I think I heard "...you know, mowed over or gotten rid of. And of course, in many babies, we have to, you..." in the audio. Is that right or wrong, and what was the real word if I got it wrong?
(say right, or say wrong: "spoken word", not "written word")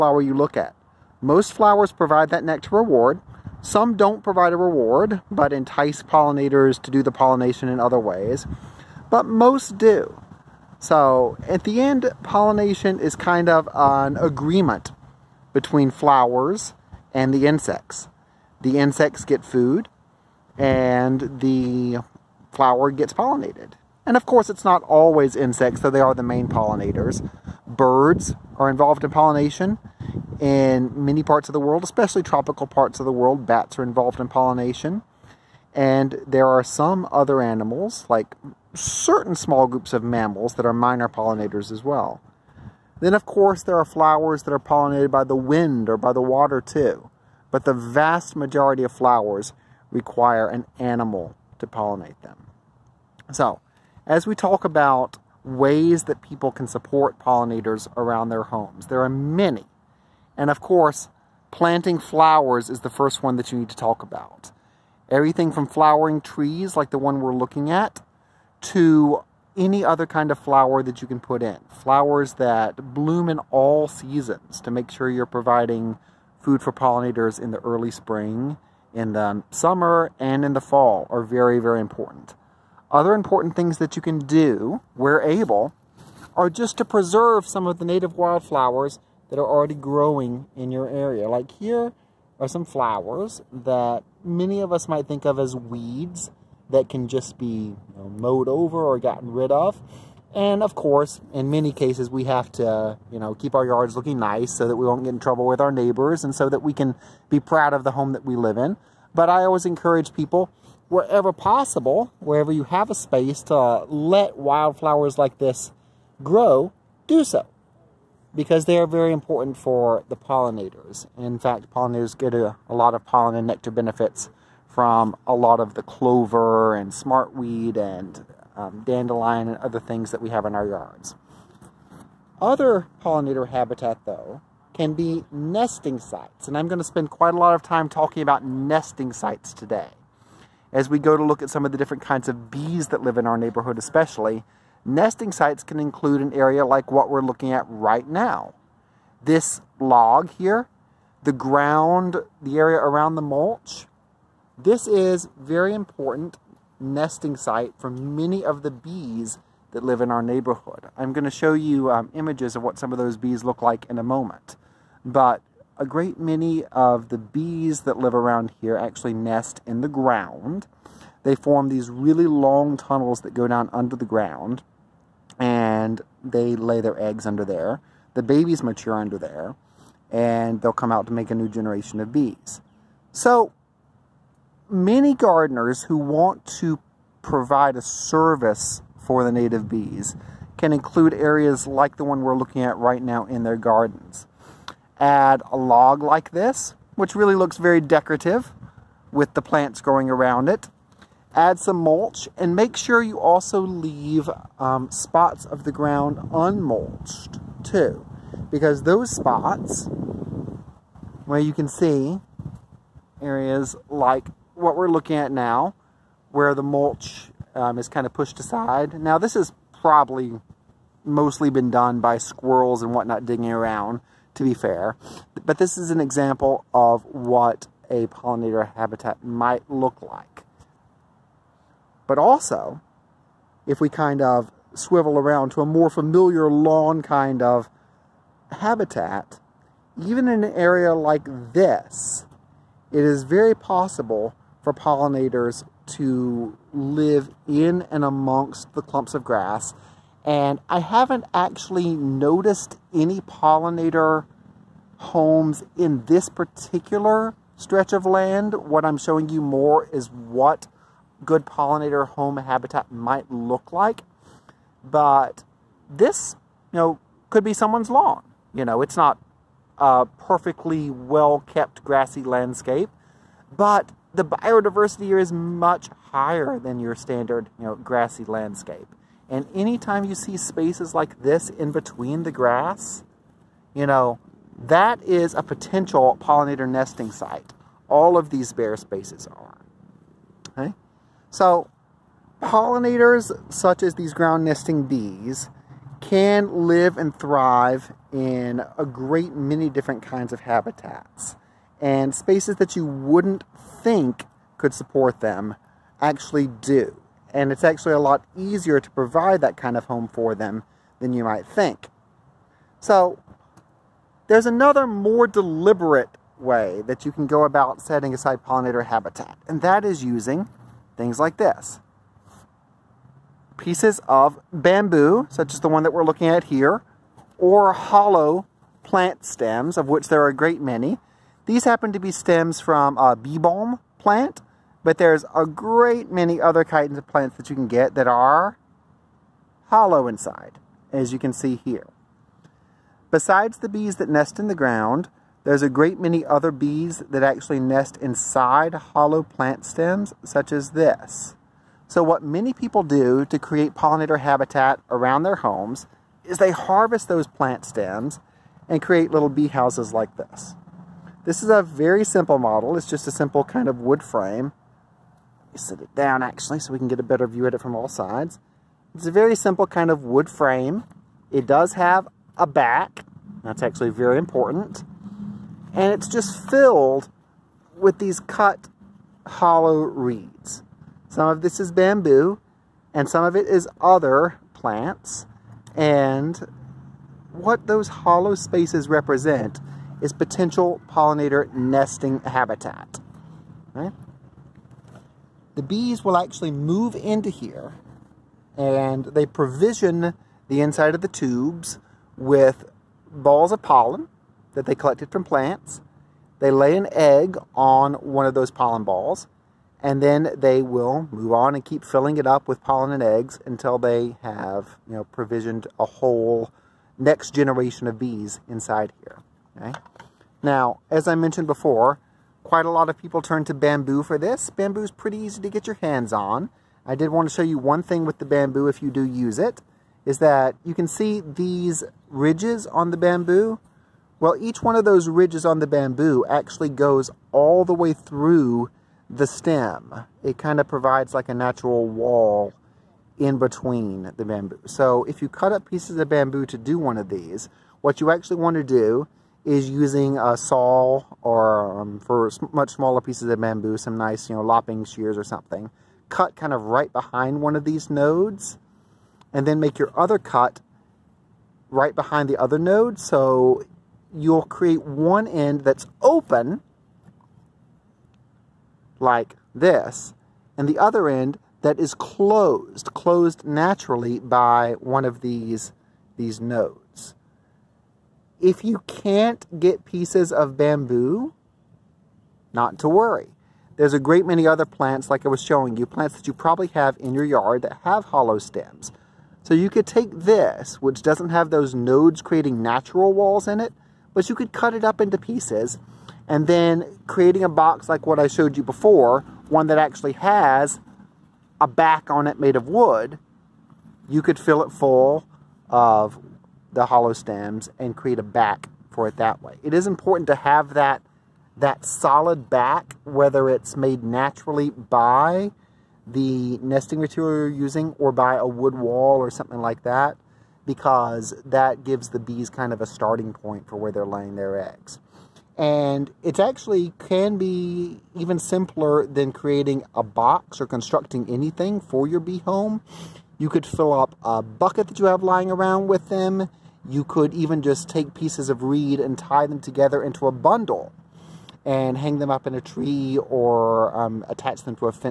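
wrong: "cases", not "babies".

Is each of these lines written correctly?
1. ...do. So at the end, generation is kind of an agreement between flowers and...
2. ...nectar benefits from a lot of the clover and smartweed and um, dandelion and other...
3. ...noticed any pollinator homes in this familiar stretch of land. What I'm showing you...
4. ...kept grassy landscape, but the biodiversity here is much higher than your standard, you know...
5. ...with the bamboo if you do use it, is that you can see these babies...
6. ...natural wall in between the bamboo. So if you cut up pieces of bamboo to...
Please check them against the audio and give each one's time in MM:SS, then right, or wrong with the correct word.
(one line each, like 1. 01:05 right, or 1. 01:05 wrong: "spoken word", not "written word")
1. 00:09 wrong: "pollination", not "generation"
2. 02:03 right
3. 04:11 wrong: "particular", not "familiar"
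4. 04:31 right
5. 07:08 wrong: "ridges", not "babies"
6. 07:21 right.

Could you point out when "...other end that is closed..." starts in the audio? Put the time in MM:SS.
07:50.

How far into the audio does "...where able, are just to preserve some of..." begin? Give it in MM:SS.
01:24.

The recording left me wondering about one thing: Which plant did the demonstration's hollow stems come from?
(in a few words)
Bee balm.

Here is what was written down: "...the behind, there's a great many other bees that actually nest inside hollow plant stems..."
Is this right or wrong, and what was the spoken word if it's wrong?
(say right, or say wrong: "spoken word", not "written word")
wrong: "ground", not "behind".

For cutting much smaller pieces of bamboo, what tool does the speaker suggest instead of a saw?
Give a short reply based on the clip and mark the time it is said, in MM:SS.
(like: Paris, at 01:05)
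Lopping shears, at 07:34.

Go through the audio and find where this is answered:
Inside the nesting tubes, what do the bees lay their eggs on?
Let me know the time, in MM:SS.
06:48.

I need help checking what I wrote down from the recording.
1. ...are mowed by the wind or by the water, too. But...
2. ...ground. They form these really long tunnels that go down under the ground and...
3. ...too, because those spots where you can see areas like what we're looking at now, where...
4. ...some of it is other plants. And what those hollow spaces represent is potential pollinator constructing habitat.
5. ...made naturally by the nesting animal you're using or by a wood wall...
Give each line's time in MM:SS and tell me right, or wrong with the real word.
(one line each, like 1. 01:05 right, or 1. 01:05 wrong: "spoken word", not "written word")
1. 00:44 wrong: "pollinated", not "mowed"
2. 02:49 right
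3. 03:27 right
4. 06:23 wrong: "nesting", not "constructing"
5. 08:33 wrong: "material", not "animal".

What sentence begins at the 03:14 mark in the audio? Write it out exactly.
Add a log like this, which really looks very decorative with the plants growing around it.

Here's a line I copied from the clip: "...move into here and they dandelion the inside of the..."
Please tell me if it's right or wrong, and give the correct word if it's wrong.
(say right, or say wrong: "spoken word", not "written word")
wrong: "provision", not "dandelion".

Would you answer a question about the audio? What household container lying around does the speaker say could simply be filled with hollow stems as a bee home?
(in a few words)
A bucket.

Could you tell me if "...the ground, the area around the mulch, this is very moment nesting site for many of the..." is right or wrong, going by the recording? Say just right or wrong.
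wrong.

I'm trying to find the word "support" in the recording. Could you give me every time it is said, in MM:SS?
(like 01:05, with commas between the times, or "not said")
00:56, 05:04.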